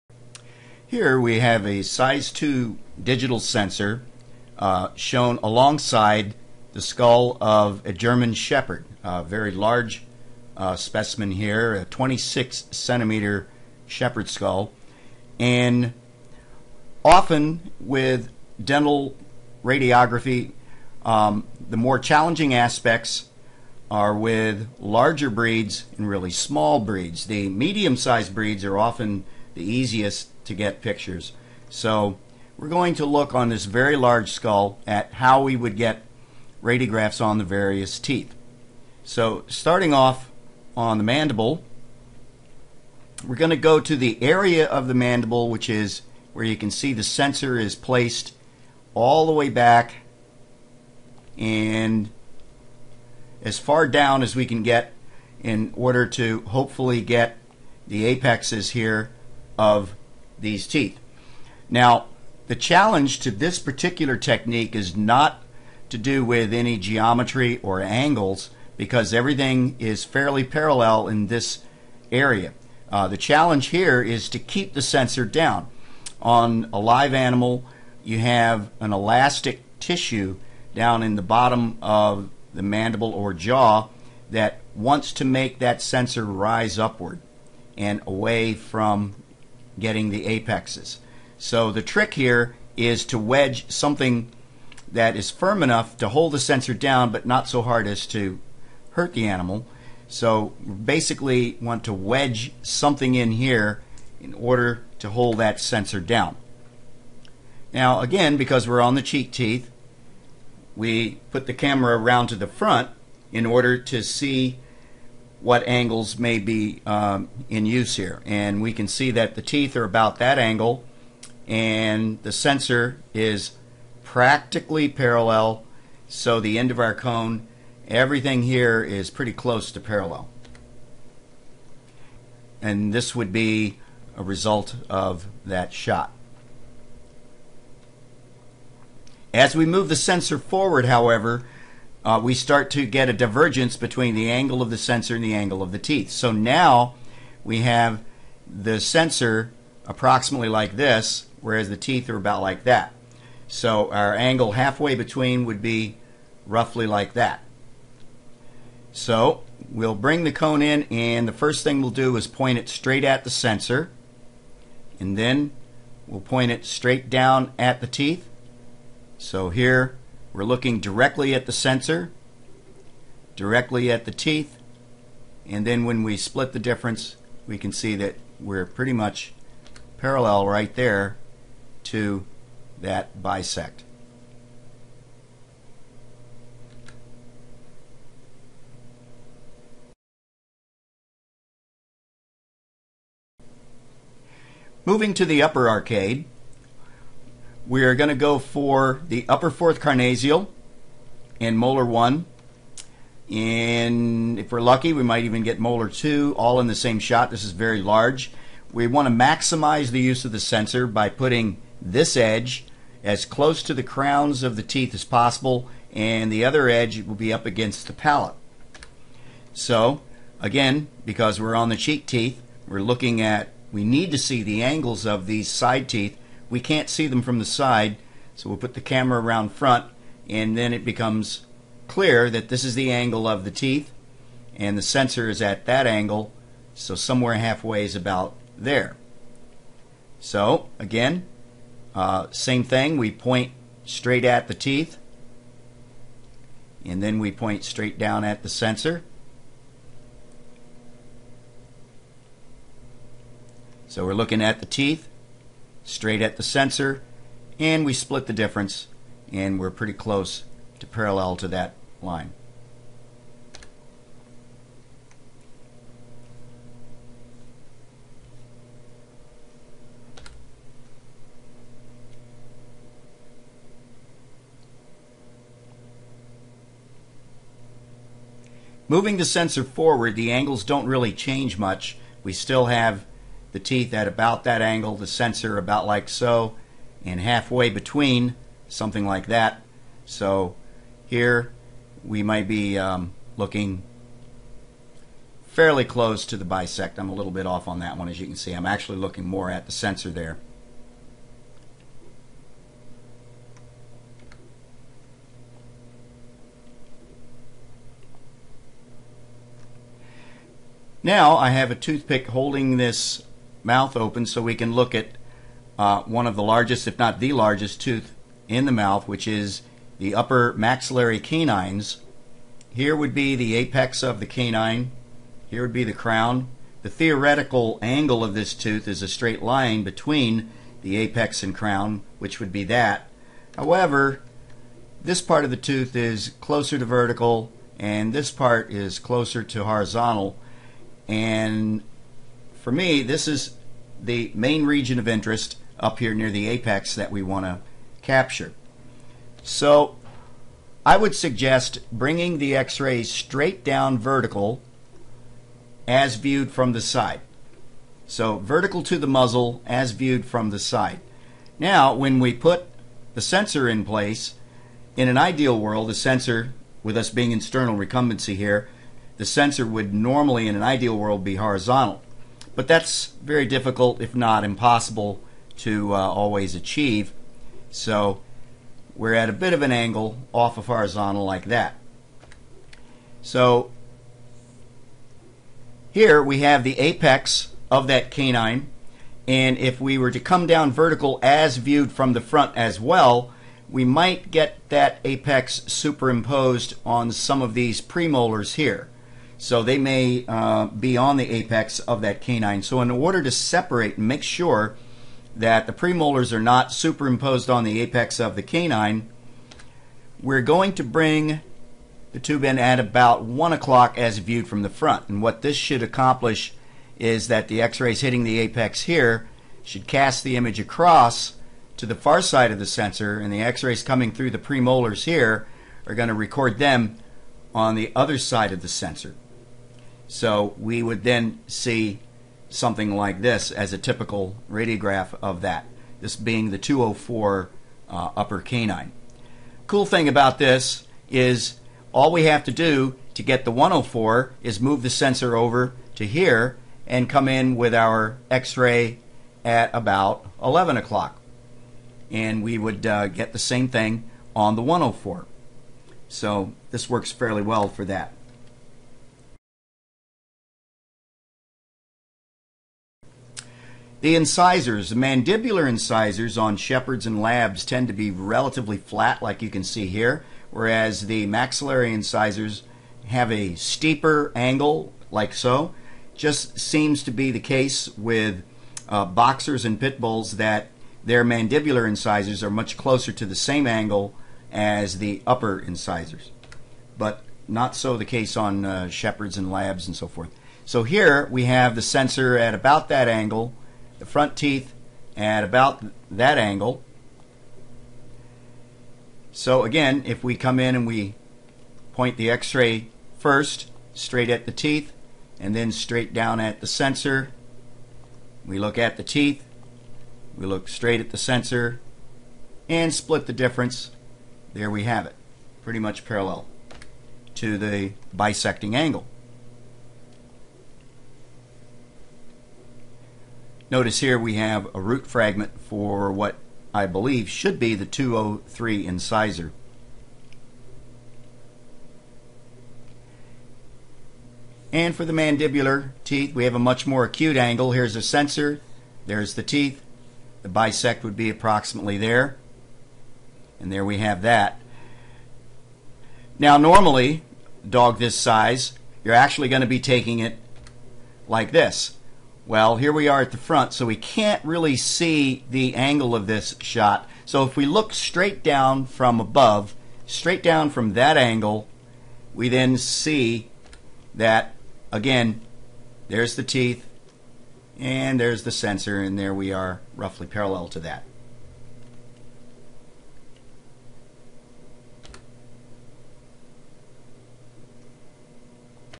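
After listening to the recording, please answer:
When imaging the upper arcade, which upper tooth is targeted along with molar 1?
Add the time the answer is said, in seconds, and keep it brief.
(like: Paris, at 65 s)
upper fourth carnassial, at 199 s.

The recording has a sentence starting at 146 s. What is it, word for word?
So now we have the sensor approximately like this, whereas the teeth are about like that.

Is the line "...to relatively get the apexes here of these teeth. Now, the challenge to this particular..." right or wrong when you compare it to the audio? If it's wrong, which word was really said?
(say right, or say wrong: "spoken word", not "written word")
wrong: "hopefully", not "relatively".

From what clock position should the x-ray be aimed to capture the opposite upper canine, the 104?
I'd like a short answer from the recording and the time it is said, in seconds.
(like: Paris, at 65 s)
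11 o'clock, at 450 s.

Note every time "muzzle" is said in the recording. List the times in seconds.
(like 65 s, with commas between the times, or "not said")
359 s.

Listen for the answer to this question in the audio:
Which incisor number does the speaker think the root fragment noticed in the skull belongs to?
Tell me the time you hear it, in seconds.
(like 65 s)
527 s.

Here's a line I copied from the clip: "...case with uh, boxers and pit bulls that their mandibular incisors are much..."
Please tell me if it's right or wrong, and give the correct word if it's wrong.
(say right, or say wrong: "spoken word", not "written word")
right.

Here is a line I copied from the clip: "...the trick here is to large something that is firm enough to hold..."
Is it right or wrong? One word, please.
wrong.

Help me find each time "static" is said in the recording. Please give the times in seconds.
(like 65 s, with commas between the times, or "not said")
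not said.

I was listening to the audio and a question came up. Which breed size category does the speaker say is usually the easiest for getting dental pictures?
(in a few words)
medium sized breeds.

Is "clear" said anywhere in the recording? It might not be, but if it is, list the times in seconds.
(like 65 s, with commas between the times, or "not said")
231 s.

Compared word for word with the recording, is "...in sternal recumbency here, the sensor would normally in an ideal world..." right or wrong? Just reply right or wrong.
right.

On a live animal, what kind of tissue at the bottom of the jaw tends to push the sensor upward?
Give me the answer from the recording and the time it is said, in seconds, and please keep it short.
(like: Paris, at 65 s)
elastic tissue, at 78 s.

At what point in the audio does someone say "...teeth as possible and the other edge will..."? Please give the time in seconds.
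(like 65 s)
214 s.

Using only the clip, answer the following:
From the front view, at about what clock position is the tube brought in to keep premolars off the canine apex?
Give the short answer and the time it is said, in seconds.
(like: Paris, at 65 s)
1 o'clock, at 413 s.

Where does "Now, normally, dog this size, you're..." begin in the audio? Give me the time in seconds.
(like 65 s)
546 s.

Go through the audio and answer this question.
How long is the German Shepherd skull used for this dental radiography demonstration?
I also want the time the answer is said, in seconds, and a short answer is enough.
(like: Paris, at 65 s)
26 centimeters, at 11 s.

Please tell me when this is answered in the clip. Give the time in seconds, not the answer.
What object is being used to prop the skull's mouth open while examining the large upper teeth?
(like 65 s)
311 s.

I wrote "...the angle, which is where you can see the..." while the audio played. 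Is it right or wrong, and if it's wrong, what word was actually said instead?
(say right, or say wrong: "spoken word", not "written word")
wrong: "mandible", not "angle".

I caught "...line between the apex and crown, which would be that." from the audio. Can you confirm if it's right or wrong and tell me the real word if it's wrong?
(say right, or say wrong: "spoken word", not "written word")
right.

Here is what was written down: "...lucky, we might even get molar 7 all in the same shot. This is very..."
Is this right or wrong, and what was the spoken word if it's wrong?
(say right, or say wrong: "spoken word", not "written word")
wrong: "2", not "7".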